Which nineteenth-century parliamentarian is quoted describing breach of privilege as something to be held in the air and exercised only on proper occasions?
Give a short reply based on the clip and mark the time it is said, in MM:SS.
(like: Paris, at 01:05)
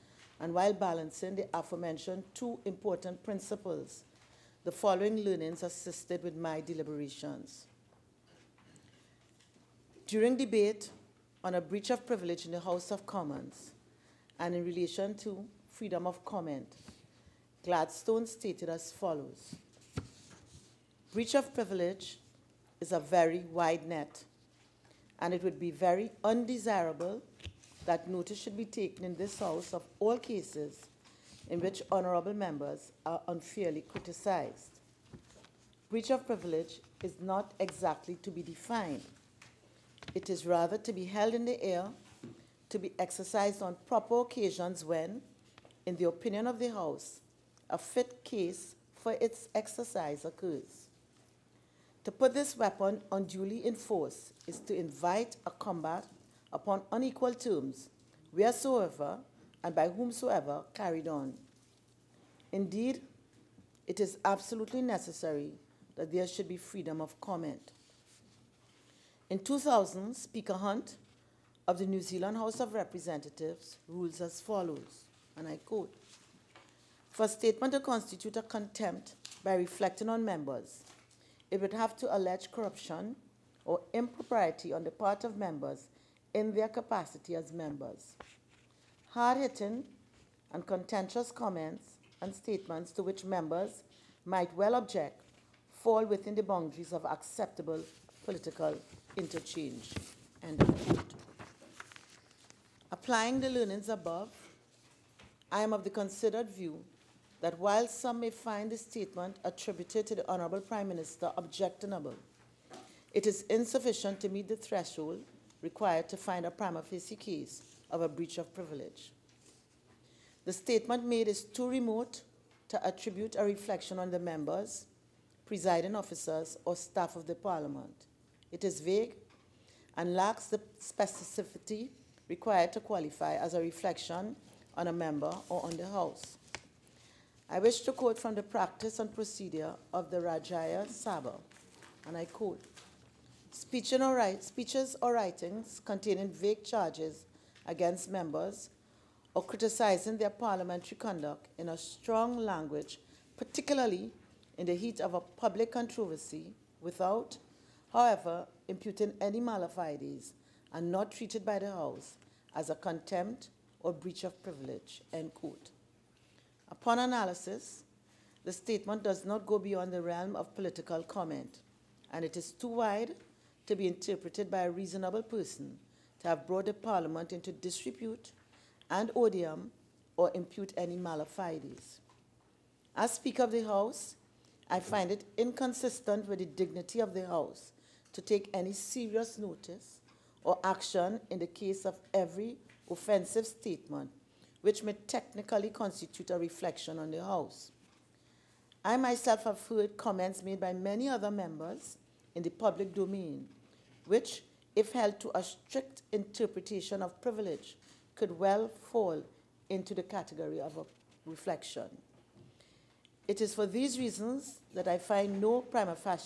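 Gladstone, at 00:17.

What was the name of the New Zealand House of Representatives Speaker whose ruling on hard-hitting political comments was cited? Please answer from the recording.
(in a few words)
Speaker Hunt.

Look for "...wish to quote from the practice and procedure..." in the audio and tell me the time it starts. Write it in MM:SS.
02:17.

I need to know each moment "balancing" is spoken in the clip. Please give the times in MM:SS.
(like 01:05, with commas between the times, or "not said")
00:00.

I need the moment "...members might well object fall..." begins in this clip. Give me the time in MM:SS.
01:33.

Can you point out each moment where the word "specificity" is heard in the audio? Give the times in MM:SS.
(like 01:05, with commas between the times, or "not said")
02:10.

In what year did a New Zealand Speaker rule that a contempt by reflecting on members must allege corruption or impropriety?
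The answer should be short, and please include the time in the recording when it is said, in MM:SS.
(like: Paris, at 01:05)
2000, at 01:09.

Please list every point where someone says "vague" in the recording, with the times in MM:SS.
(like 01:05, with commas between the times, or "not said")
02:08, 02:26.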